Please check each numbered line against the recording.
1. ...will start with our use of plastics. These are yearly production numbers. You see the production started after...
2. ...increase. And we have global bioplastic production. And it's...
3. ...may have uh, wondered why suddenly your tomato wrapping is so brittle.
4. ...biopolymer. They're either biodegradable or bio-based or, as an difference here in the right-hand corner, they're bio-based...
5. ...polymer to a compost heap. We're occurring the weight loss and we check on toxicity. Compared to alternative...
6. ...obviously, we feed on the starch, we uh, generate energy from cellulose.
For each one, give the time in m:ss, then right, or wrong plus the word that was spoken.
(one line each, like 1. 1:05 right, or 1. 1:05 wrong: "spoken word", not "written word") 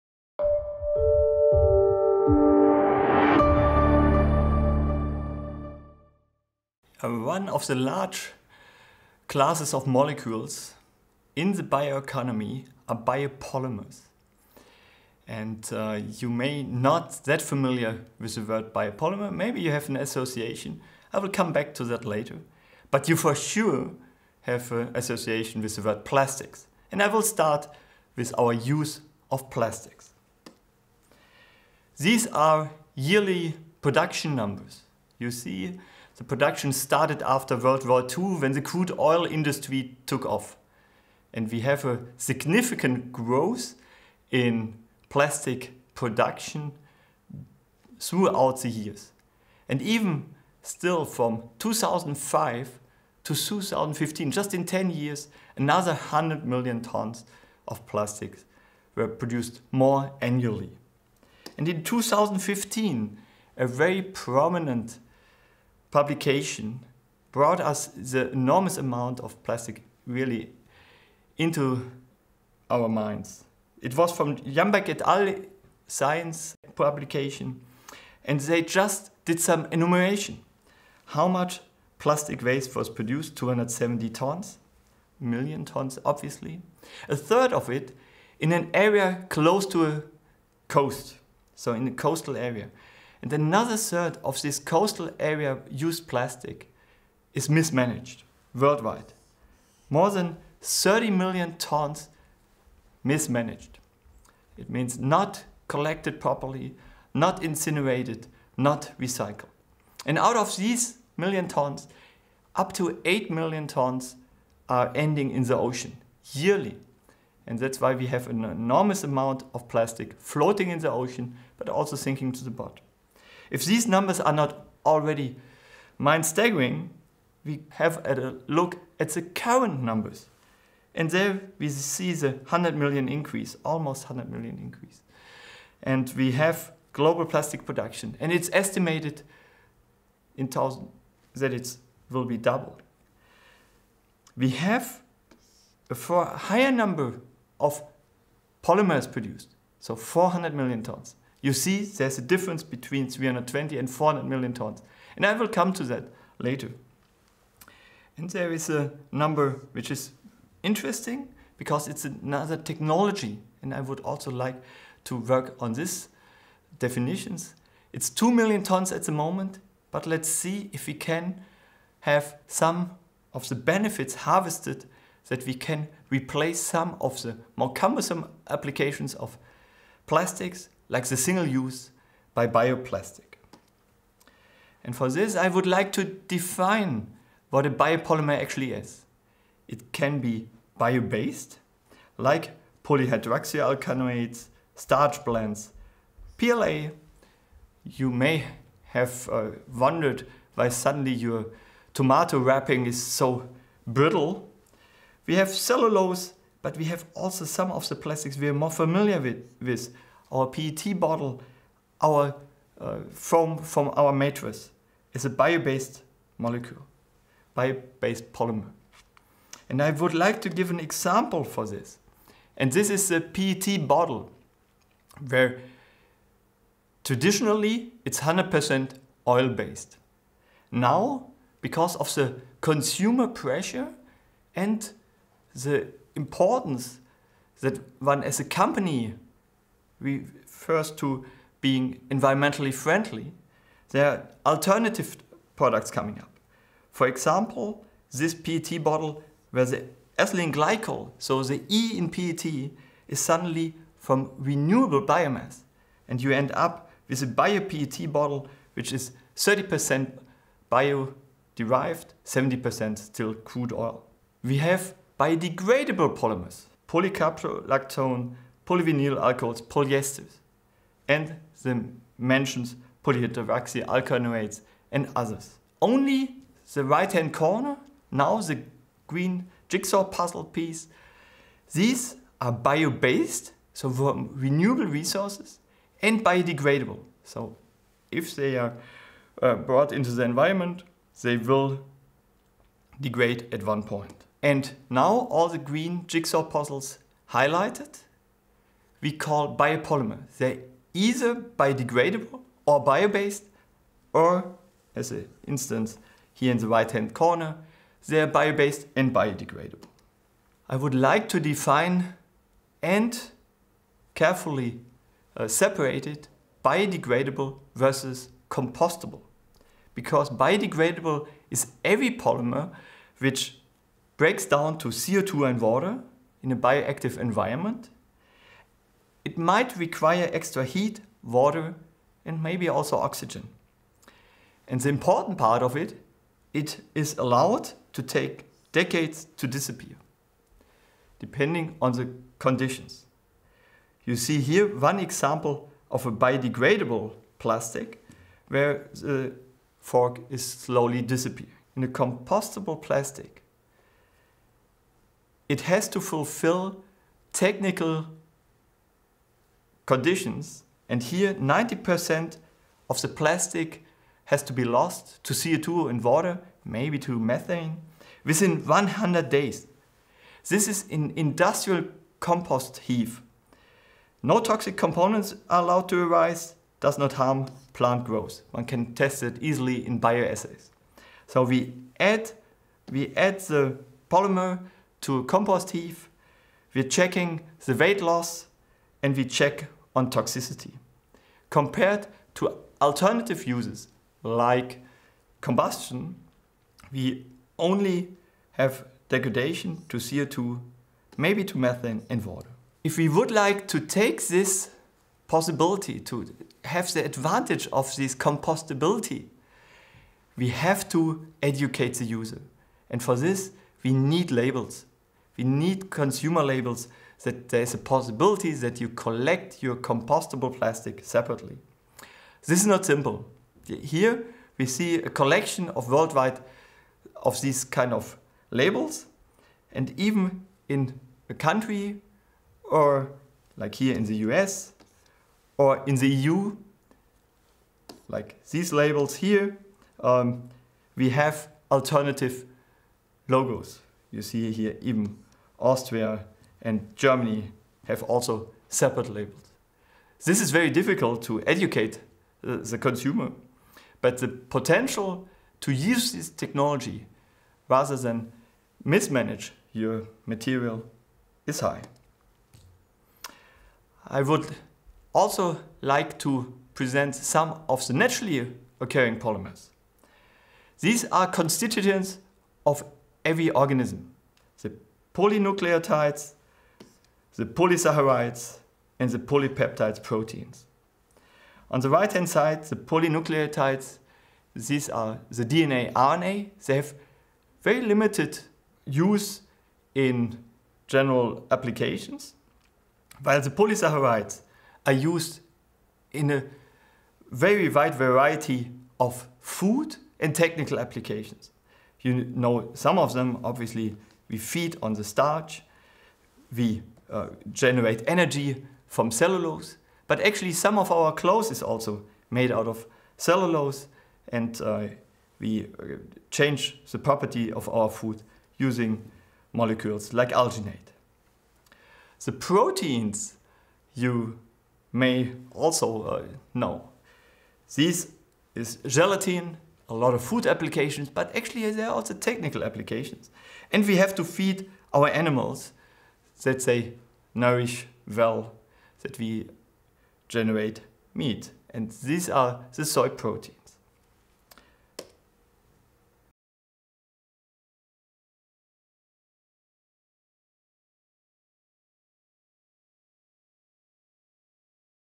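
1. 0:27 right
2. 2:14 wrong: "plastic", not "bioplastic"
3. 3:18 right
4. 4:59 wrong: "instance", not "difference"
5. 6:24 wrong: "checking", not "occurring"
6. 8:23 right.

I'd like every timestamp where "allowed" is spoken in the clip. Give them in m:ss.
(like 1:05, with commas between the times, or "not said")
5:37, 6:15.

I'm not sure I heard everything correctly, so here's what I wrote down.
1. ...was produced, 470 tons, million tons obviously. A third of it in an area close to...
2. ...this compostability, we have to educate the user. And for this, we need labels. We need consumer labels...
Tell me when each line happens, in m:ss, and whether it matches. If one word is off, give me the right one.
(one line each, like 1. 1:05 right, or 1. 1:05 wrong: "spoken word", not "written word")
1. 1:22 wrong: "270", not "470"
2. 6:47 right.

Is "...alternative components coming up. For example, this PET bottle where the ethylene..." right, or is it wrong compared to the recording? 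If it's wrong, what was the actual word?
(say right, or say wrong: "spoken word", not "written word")
wrong: "products", not "components".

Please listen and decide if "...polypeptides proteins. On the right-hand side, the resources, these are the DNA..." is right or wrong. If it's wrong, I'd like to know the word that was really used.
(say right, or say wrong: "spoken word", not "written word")
wrong: "polynucleotides", not "resources".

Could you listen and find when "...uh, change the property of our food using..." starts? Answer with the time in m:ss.
8:35.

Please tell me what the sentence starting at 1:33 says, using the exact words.
And another third of this coastal area used plastic is mismanaged worldwide.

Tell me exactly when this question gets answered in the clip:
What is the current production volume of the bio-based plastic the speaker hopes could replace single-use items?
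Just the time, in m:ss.
2:48.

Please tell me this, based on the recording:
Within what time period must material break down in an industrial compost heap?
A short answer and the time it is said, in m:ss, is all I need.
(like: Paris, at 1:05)
100 days, at 6:08.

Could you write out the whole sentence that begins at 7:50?
These are constituents of every organism.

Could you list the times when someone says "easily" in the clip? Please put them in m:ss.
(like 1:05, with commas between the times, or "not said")
6:19.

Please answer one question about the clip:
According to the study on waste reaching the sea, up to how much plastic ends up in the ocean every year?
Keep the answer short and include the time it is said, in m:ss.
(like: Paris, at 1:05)
8 million tons, at 1:53.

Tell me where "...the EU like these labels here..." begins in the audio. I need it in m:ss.
7:15.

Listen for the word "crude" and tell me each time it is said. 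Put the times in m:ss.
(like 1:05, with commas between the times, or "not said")
0:38, 4:23.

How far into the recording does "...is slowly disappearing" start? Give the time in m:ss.
5:50.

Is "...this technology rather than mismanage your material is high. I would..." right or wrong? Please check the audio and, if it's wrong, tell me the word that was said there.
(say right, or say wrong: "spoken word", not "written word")
right.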